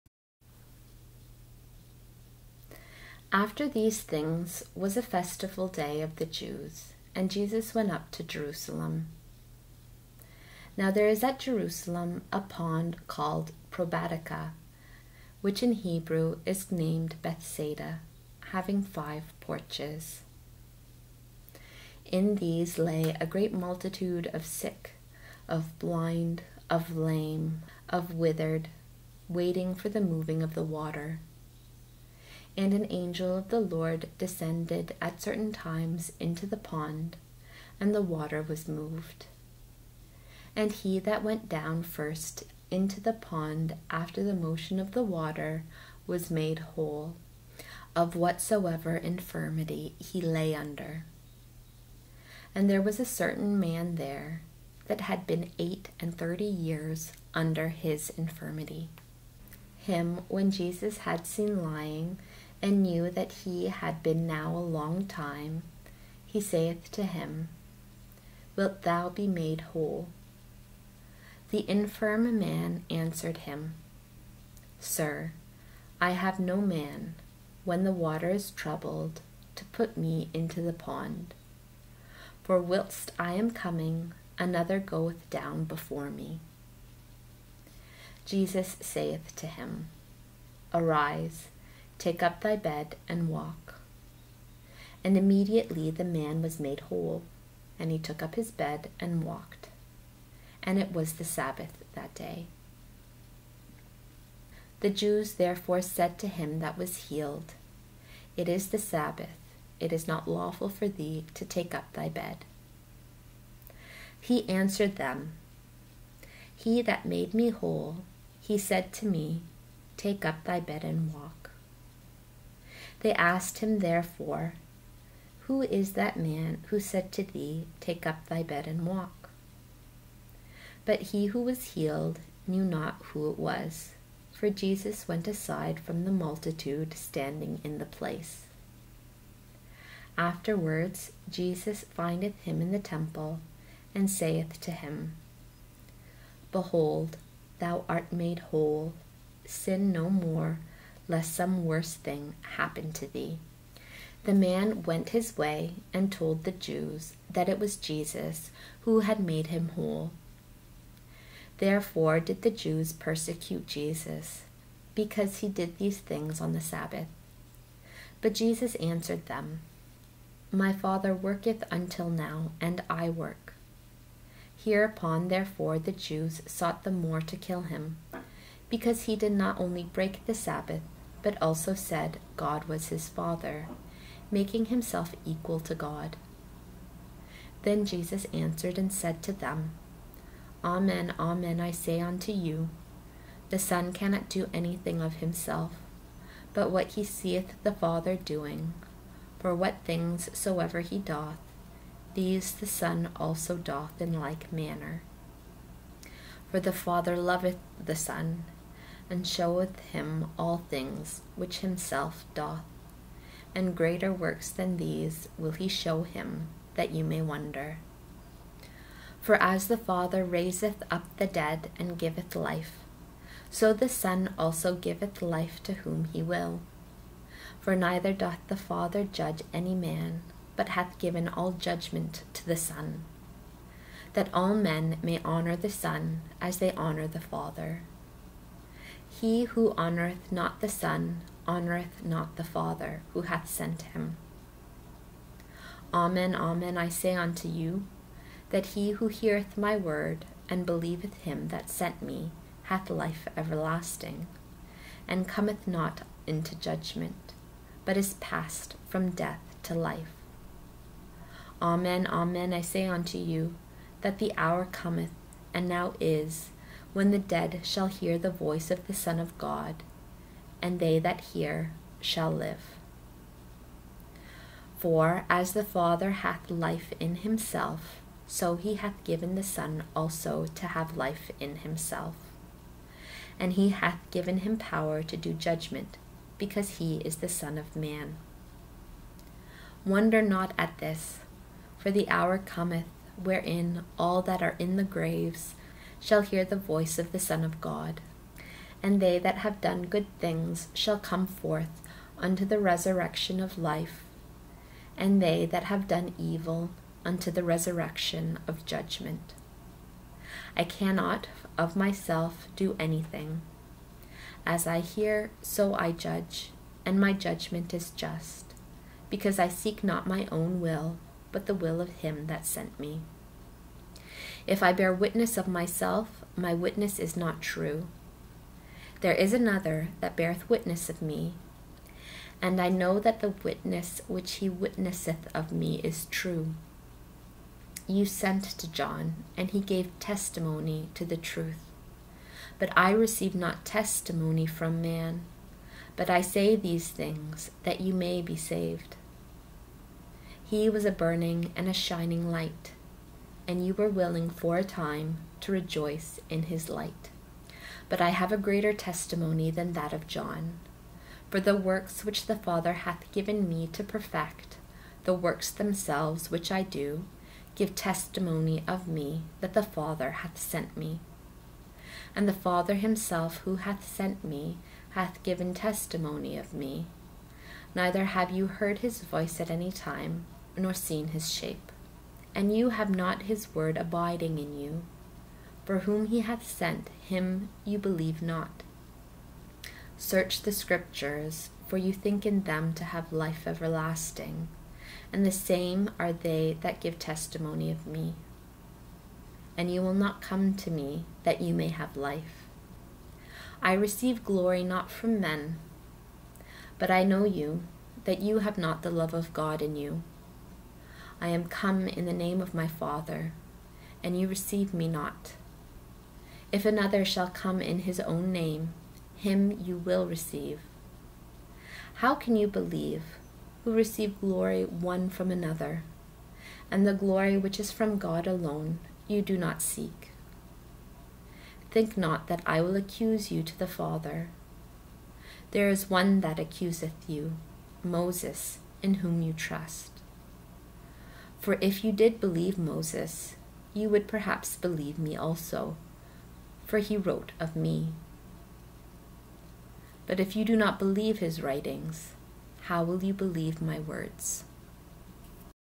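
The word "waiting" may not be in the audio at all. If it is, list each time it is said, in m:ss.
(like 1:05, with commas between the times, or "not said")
0:29.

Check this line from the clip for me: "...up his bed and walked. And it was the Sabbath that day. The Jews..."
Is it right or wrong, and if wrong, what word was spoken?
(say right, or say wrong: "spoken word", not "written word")
right.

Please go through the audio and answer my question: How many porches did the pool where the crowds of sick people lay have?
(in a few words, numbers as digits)
5.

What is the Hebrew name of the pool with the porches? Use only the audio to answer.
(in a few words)
Bethsaida.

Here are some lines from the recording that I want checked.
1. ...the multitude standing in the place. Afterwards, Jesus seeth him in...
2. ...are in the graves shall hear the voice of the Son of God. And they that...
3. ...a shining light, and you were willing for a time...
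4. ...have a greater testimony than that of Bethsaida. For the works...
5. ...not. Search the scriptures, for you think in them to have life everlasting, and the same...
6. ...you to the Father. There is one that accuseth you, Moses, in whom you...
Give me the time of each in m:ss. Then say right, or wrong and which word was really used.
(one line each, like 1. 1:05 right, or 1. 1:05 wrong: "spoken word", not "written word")
1. 2:16 wrong: "findeth", not "seeth"
2. 4:54 right
3. 5:51 right
4. 5:58 wrong: "John", not "Bethsaida"
5. 6:28 right
6. 7:13 right.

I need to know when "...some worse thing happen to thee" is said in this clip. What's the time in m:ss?
2:31.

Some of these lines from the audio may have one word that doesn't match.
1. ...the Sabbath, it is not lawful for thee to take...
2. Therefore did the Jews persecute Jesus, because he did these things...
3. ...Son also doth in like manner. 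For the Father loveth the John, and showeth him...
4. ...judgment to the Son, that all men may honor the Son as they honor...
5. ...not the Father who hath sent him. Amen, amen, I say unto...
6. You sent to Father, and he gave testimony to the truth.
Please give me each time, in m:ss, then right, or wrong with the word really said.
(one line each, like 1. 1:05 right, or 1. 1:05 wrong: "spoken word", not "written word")
1. 1:48 right
2. 2:41 right
3. 3:22 wrong: "Son", not "John"
4. 3:51 right
5. 4:02 right
6. 5:37 wrong: "John", not "Father".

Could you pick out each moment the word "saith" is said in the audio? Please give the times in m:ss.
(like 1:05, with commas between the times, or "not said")
1:06, 1:28, 2:24.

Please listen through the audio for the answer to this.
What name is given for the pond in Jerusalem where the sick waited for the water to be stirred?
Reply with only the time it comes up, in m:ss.
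0:13.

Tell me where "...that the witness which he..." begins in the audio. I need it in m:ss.
5:32.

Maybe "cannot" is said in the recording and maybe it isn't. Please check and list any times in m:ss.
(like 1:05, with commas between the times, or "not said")
3:13, 5:10.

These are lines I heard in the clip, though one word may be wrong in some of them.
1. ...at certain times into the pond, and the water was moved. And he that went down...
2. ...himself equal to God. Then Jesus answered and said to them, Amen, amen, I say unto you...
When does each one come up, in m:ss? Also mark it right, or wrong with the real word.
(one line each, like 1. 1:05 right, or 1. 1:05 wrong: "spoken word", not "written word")
1. 0:35 right
2. 3:04 right.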